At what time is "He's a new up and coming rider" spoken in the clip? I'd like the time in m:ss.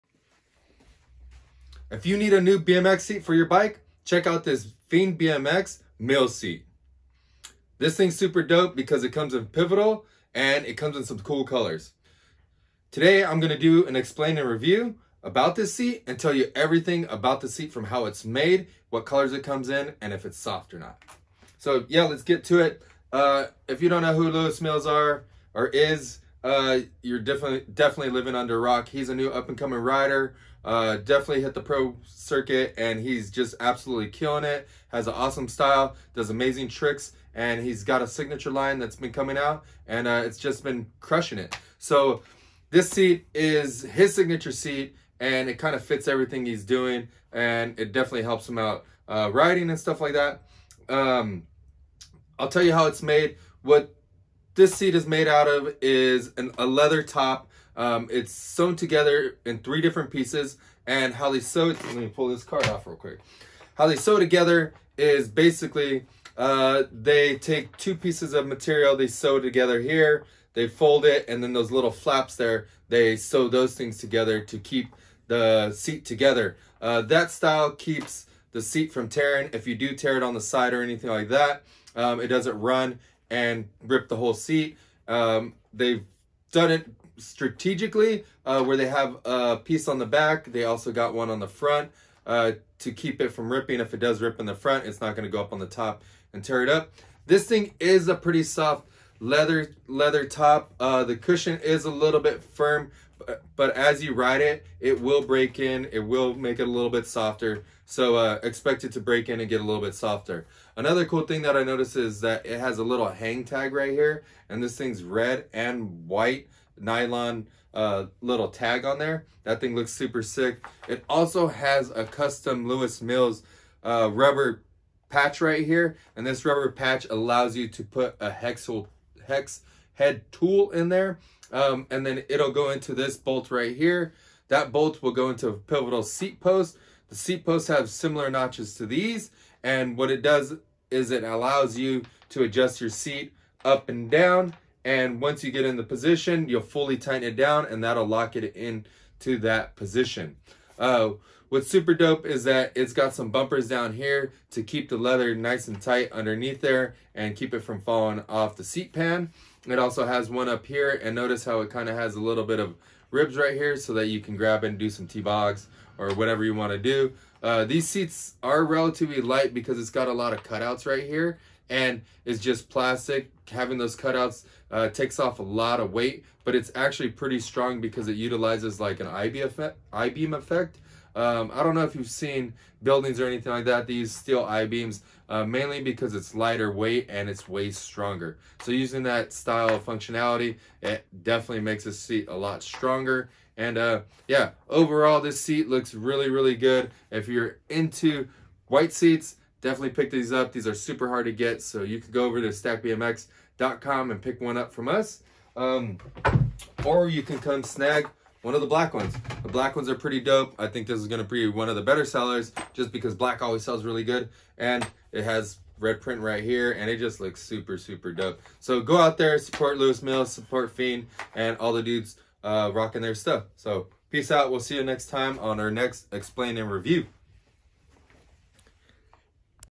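0:28.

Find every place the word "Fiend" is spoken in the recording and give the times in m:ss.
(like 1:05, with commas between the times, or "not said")
0:04, 3:40.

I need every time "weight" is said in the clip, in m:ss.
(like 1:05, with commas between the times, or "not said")
2:55, 3:06.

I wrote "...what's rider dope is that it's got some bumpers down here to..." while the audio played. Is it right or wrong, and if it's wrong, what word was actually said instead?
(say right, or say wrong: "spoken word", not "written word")
wrong: "super", not "rider".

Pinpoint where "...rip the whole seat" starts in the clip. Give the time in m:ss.
1:23.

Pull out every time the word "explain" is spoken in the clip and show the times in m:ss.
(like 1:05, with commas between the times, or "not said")
0:13, 3:46.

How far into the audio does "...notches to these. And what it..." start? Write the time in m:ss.
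2:18.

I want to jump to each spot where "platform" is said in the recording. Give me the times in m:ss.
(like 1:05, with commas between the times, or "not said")
not said.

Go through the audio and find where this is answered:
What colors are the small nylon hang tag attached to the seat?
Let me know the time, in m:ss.
1:55.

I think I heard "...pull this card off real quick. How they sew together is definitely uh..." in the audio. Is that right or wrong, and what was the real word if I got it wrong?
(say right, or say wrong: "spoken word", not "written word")
wrong: "basically", not "definitely".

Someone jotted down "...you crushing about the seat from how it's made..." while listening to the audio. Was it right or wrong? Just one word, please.
wrong.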